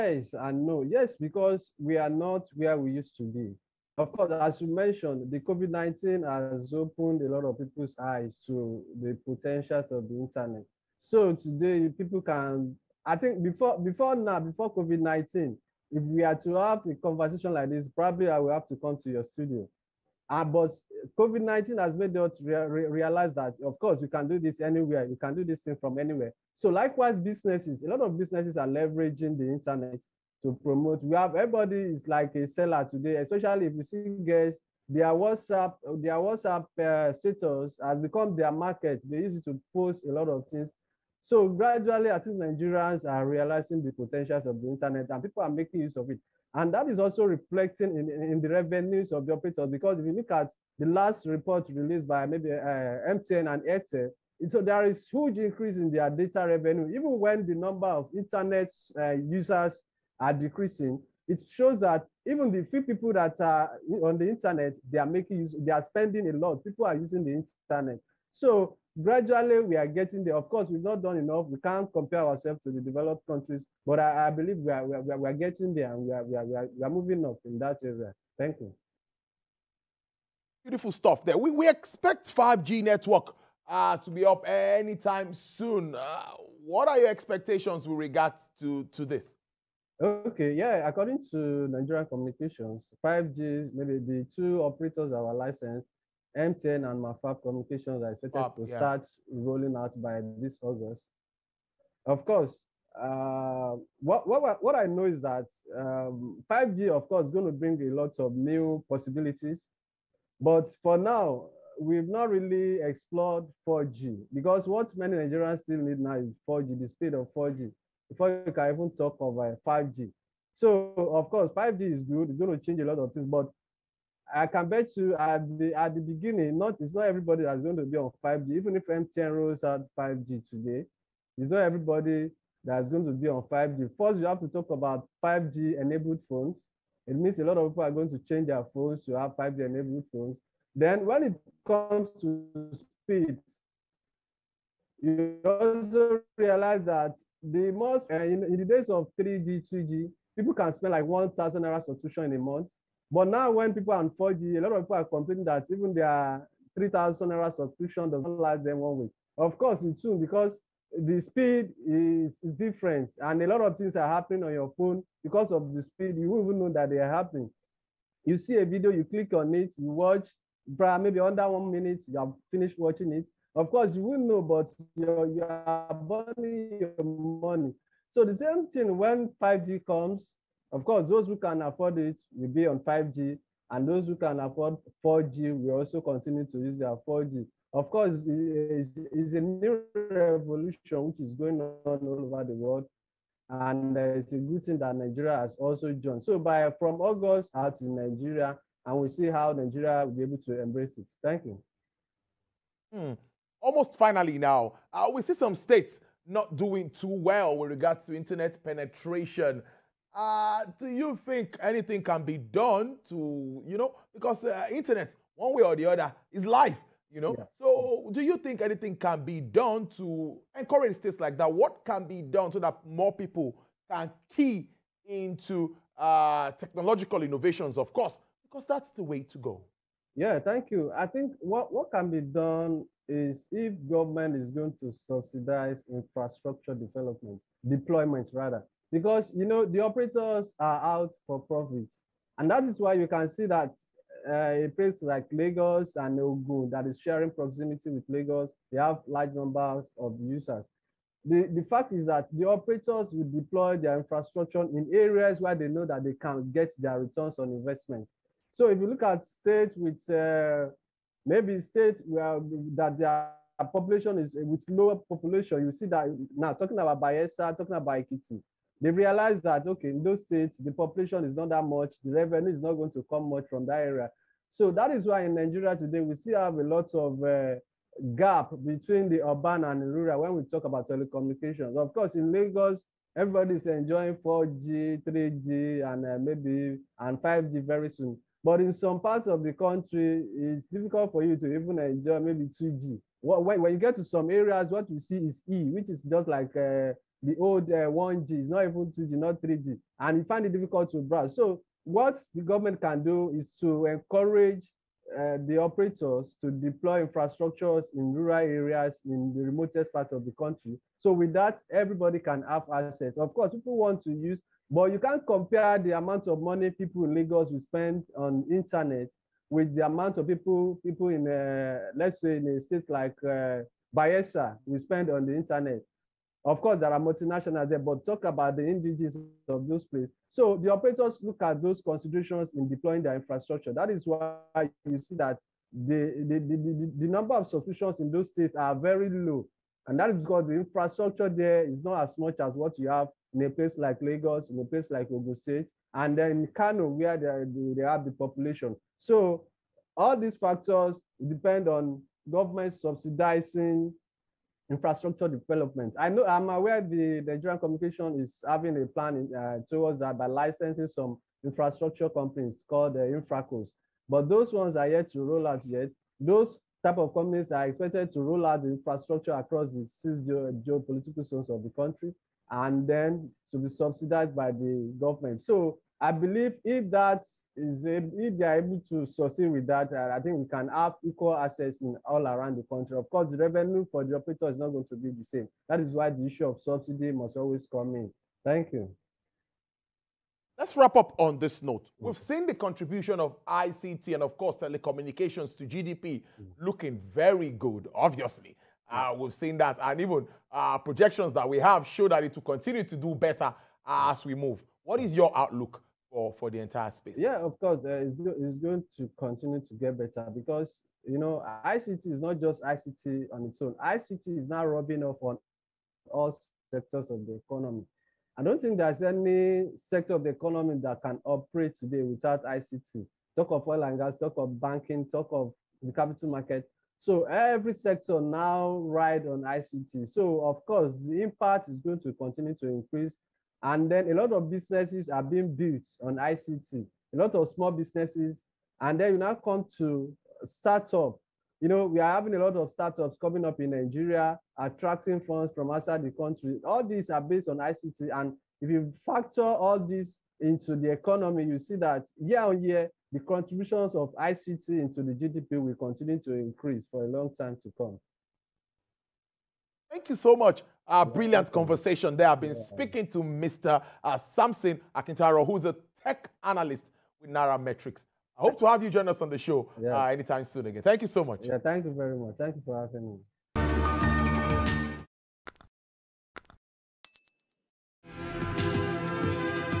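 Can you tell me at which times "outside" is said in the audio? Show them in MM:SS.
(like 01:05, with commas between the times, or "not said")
07:25.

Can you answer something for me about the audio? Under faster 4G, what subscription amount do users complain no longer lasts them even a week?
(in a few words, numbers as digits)
3,000 naira.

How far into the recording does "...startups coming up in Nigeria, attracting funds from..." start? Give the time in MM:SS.
07:22.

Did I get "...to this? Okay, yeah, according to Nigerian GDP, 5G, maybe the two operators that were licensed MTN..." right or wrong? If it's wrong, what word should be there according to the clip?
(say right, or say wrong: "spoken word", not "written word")
wrong: "Communications", not "GDP".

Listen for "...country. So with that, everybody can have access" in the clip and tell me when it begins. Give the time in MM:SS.
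05:10.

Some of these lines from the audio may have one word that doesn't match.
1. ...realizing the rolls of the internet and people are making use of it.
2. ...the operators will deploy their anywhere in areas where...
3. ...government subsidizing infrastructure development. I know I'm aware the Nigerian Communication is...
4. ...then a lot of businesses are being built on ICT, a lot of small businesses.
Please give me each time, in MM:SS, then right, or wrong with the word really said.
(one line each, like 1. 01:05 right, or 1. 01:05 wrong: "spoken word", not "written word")
1. 00:43 wrong: "potentials", not "rolls"
2. 04:12 wrong: "infrastructure", not "anywhere"
3. 05:52 right
4. 07:13 right.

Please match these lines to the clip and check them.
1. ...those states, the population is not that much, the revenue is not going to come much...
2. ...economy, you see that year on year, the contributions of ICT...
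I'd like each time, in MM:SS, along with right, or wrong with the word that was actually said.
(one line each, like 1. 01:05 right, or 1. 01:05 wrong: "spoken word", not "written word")
1. 04:30 right
2. 07:30 right.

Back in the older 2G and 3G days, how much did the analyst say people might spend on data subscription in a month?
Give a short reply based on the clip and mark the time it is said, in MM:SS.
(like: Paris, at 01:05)
1,000 naira, at 02:31.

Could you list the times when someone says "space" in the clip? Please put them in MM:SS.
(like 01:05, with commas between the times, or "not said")
06:46.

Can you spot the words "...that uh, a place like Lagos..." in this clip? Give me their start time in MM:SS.
04:03.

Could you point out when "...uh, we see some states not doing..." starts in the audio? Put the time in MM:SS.
03:24.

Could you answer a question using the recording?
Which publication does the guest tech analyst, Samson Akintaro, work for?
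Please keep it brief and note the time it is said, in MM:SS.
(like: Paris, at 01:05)
Nairametrics, at 07:47.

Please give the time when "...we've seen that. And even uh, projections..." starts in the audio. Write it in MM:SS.
06:39.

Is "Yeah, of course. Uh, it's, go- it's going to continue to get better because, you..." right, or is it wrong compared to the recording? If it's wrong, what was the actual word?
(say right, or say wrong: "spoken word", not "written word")
right.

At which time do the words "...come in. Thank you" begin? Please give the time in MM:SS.
06:27.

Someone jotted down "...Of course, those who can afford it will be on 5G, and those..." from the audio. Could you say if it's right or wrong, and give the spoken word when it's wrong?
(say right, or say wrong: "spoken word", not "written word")
right.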